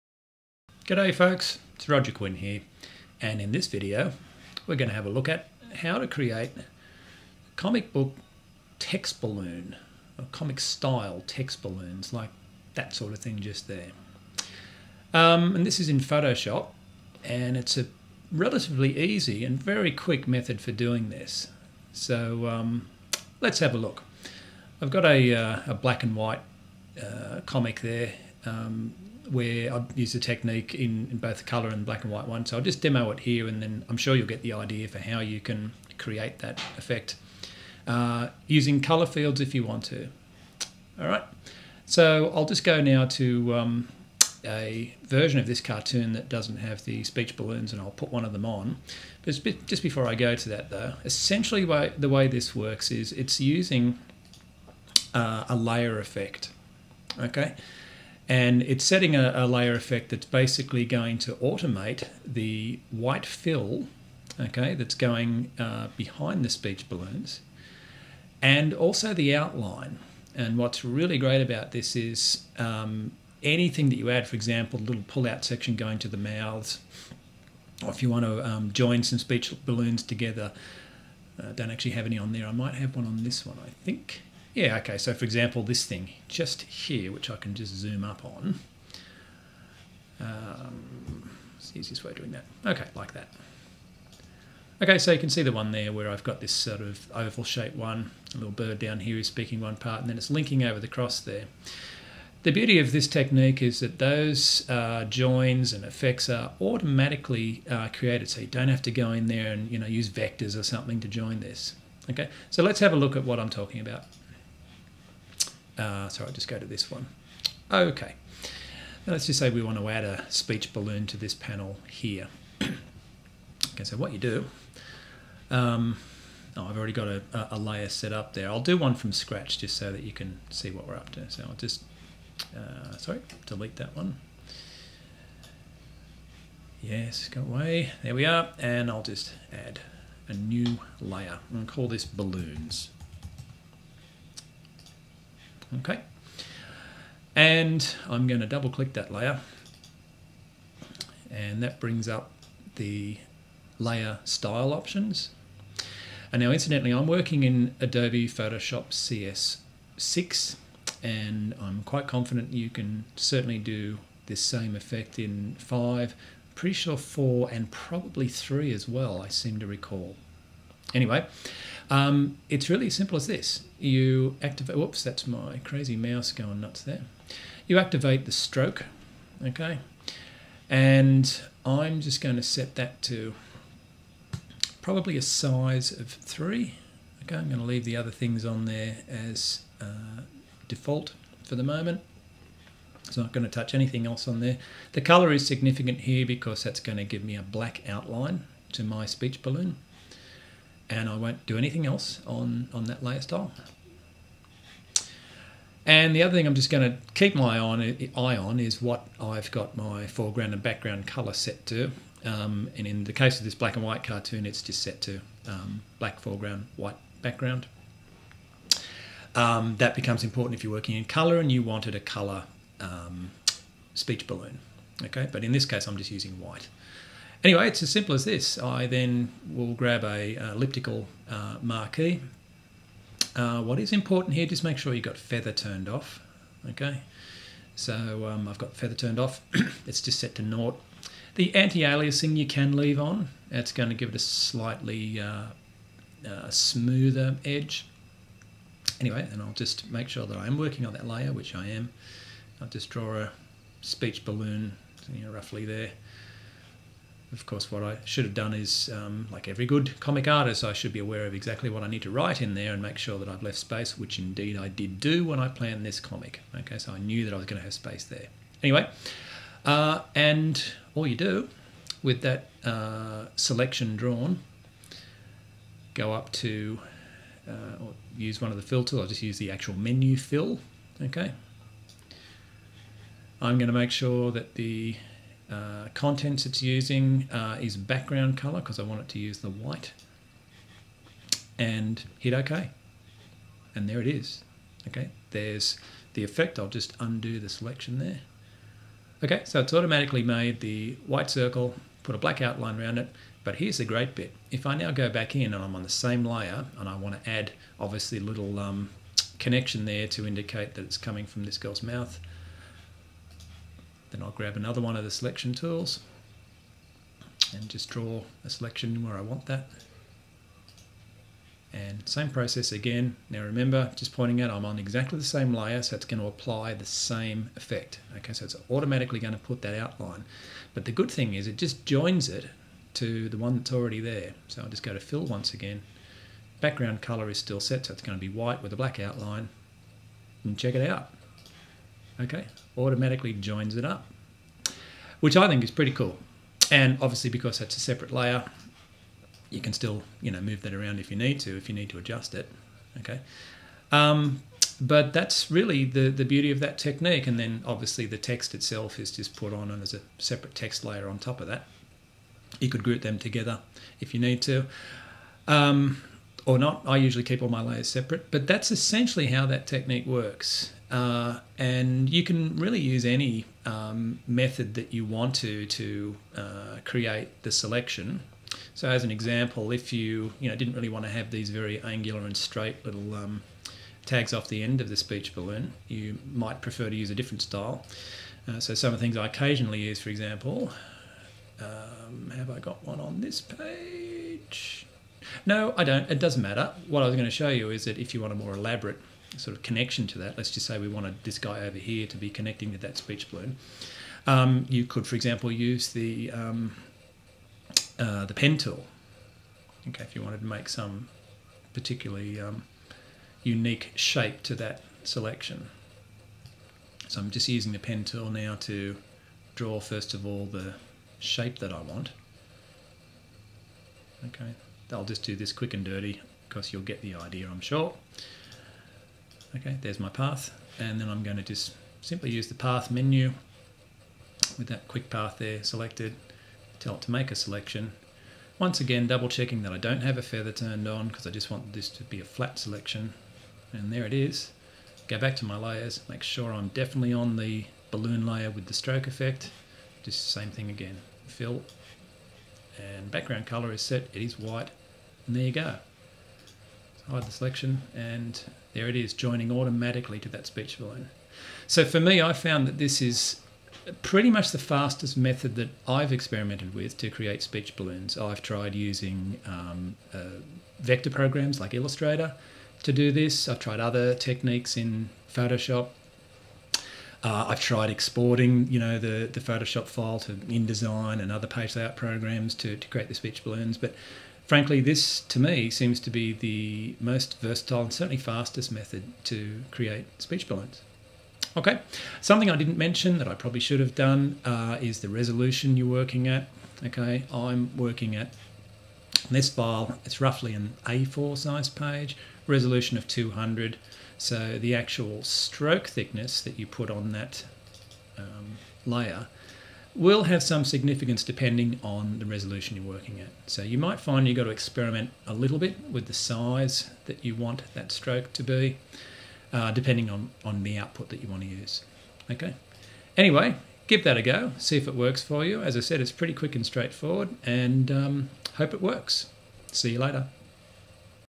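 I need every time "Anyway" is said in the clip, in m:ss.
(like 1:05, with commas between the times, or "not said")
2:50, 3:47, 4:08, 4:28, 8:43.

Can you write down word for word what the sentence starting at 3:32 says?
Um, and in the case of this black and white cartoon, it's just set to um, black foreground, white background.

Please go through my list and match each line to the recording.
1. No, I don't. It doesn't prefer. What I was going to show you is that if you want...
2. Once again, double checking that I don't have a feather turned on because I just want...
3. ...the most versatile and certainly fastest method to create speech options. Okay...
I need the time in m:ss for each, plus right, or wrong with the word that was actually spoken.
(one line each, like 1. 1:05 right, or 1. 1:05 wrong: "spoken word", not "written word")
1. 6:35 wrong: "matter", not "prefer"
2. 7:18 right
3. 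8:06 wrong: "balloons", not "options".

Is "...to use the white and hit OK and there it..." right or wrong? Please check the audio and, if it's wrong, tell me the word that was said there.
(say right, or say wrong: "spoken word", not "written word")
right.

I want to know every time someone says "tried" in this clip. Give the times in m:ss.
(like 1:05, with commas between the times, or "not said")
7:48, 7:53, 7:57.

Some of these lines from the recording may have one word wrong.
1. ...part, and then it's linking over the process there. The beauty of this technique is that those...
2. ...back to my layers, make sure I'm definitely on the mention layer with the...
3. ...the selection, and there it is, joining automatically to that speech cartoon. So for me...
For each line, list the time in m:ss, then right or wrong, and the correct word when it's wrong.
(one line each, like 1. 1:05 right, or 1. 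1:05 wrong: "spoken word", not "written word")
1. 1:39 wrong: "cross", not "process"
2. 7:25 wrong: "balloon", not "mention"
3. 7:37 wrong: "balloon", not "cartoon".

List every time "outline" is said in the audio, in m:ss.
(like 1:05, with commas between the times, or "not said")
1:09, 3:17, 5:02, 5:29, 5:38.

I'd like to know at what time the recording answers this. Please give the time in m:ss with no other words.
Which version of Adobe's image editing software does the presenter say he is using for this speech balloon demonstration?
2:37.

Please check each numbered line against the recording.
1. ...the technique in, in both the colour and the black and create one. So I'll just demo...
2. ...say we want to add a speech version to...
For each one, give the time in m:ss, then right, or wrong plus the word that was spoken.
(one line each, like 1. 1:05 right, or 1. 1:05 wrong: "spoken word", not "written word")
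1. 0:30 wrong: "white", not "create"
2. 1:59 wrong: "balloon", not "version".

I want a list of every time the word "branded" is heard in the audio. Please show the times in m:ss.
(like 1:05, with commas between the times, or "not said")
not said.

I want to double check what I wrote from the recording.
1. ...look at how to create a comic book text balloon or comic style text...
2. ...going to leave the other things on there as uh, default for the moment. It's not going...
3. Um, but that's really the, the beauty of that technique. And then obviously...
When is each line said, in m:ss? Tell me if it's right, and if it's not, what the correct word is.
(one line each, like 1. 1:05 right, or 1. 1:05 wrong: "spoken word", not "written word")
1. 0:05 right
2. 3:07 right
3. 5:53 right.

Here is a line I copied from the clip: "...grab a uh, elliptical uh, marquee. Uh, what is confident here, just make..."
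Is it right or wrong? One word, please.
wrong.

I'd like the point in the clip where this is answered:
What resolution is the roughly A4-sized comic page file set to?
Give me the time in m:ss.
8:22.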